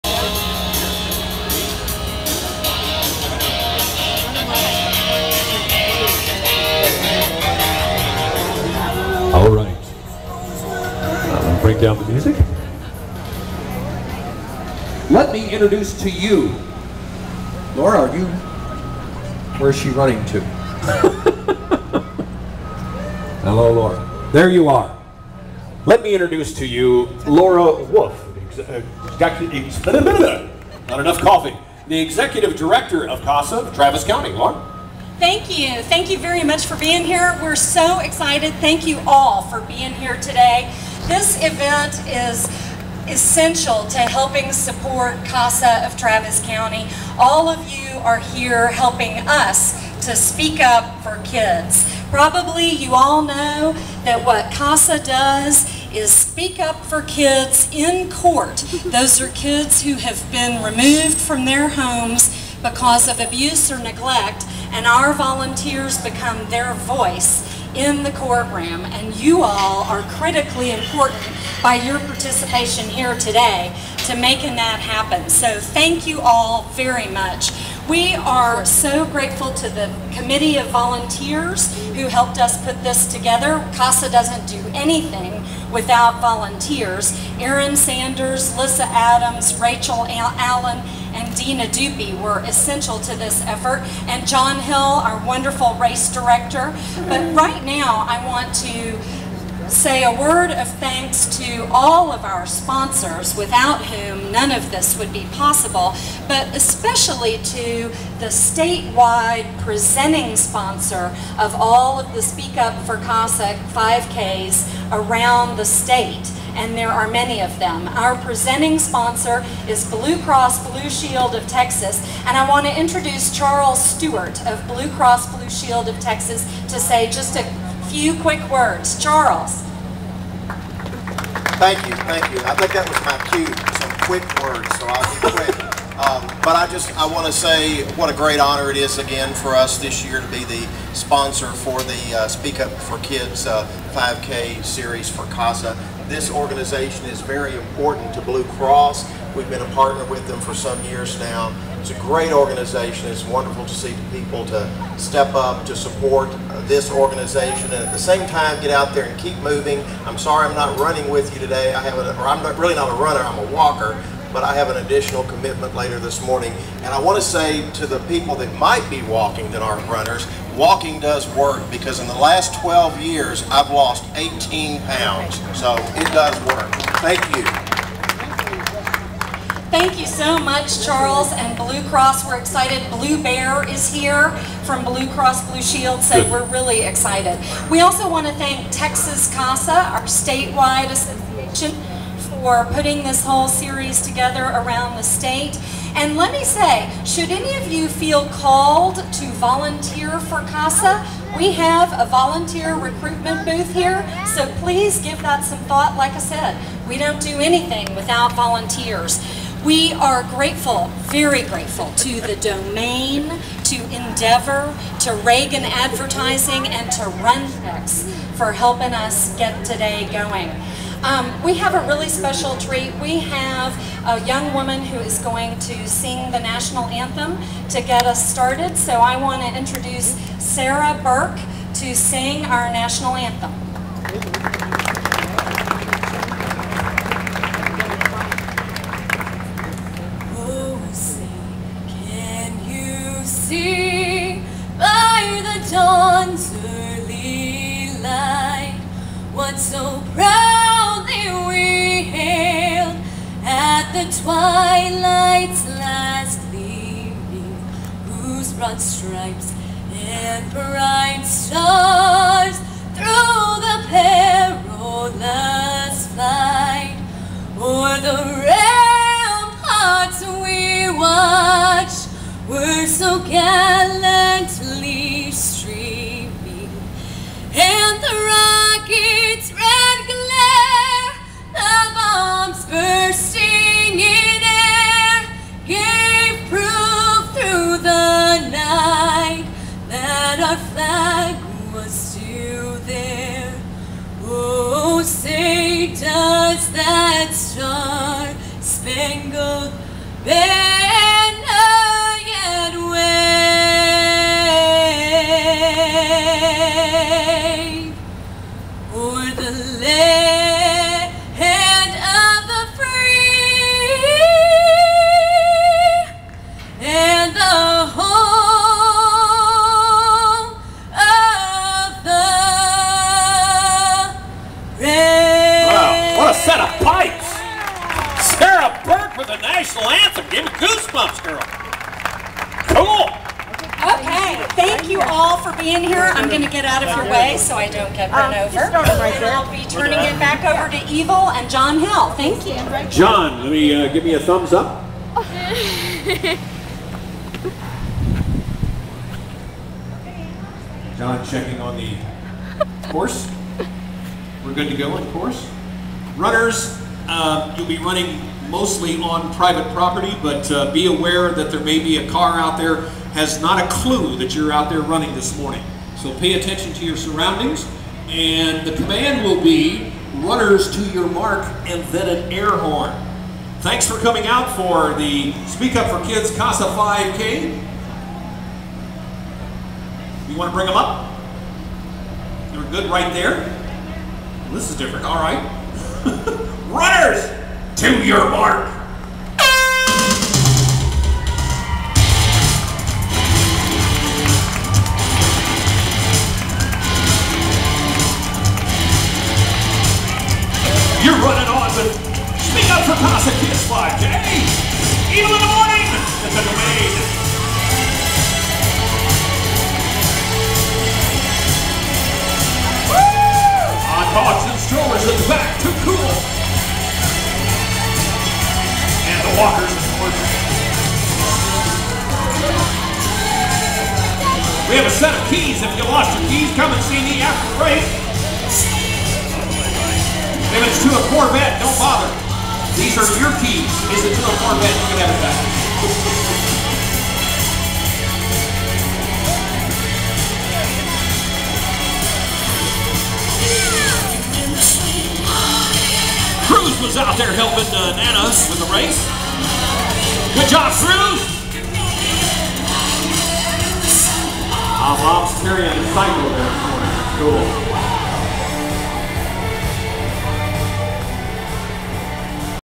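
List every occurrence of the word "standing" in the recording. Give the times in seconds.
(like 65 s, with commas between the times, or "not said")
not said.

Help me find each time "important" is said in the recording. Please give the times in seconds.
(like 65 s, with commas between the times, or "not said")
70 s, 147 s.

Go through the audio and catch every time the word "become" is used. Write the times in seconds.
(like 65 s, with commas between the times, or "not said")
66 s.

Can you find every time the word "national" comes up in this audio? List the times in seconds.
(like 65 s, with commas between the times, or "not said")
226 s, 232 s.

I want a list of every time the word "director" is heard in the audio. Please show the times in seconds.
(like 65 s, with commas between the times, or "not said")
32 s, 96 s.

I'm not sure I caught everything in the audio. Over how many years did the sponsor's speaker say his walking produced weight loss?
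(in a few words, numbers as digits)
12.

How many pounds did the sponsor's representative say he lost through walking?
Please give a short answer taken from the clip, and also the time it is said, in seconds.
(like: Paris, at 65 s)
18, at 174 s.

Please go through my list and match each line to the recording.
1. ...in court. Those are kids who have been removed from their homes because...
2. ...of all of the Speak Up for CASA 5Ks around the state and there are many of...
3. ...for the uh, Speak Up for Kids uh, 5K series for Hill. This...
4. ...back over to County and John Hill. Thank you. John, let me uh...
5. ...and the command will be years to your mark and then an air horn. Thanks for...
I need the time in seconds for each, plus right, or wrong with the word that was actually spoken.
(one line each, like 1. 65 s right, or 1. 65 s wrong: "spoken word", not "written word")
1. 57 s right
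2. 111 s right
3. 141 s wrong: "CASA", not "Hill"
4. 340 s wrong: "Evil", not "County"
5. 368 s wrong: "runners", not "years".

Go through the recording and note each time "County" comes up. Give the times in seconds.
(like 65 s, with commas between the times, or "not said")
34 s, 46 s.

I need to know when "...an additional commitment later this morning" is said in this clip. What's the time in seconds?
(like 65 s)
164 s.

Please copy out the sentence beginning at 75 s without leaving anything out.
So thank you all very much.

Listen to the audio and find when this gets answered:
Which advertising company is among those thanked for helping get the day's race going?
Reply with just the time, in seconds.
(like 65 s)
215 s.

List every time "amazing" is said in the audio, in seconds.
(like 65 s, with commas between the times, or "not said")
not said.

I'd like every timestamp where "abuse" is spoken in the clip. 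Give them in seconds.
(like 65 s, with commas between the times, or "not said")
63 s.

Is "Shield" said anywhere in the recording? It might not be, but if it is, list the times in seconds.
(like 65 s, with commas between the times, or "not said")
120 s, 125 s, 185 s.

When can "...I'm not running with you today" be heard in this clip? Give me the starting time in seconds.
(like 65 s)
160 s.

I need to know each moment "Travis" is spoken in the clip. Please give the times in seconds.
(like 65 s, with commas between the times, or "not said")
33 s, 45 s.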